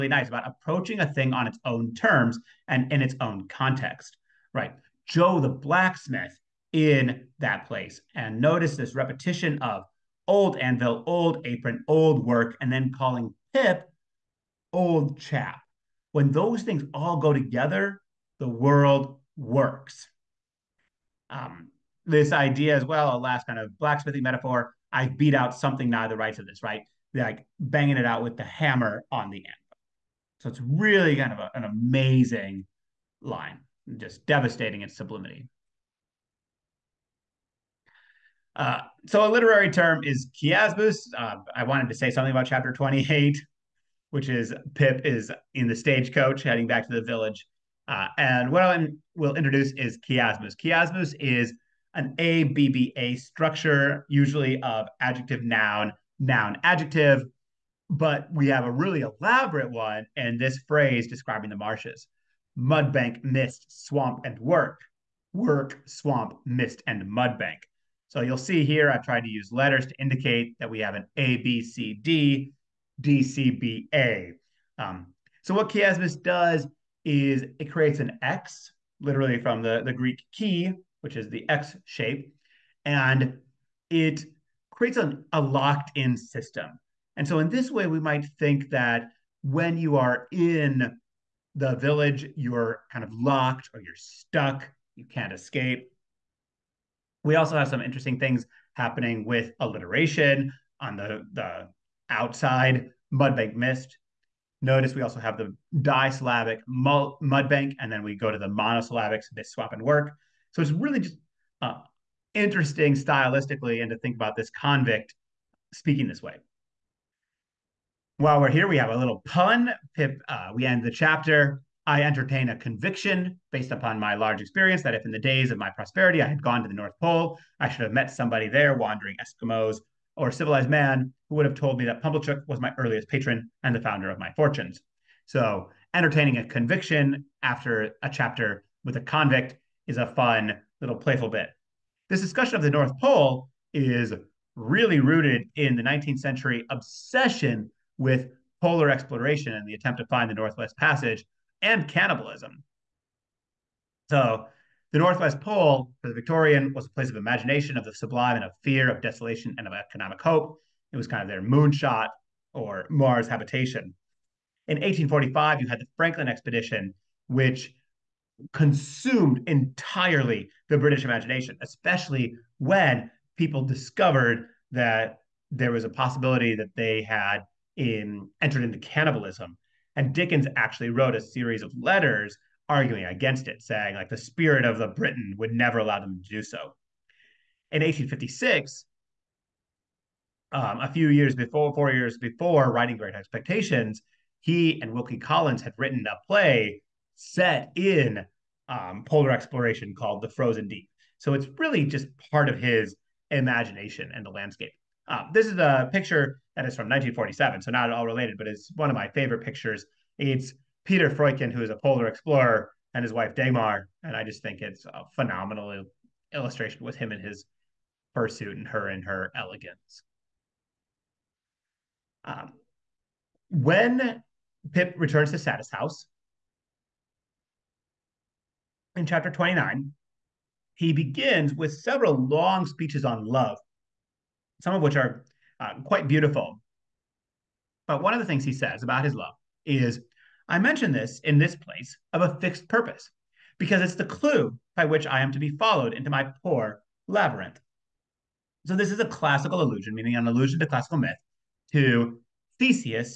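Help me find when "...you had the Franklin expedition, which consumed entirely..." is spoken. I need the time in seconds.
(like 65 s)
165 s.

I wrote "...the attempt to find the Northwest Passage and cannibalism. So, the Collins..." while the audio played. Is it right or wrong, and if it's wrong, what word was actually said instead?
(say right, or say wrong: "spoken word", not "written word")
wrong: "Northwest", not "Collins".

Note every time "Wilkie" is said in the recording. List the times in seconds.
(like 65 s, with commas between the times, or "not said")
194 s.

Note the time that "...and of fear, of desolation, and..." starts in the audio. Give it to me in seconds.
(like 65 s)
158 s.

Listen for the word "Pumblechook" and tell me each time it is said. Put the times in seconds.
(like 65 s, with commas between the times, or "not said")
132 s.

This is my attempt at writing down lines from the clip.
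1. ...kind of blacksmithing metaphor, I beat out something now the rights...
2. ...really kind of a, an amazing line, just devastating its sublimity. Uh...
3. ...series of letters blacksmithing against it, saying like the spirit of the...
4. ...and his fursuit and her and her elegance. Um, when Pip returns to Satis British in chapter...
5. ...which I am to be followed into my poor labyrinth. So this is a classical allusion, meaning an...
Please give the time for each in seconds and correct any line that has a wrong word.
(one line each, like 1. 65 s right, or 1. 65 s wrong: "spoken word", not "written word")
1. 23 s right
2. 30 s right
3. 181 s wrong: "arguing", not "blacksmithing"
4. 217 s wrong: "House", not "British"
5. 244 s right.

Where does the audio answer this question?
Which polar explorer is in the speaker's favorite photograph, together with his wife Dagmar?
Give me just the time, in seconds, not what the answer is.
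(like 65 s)
210 s.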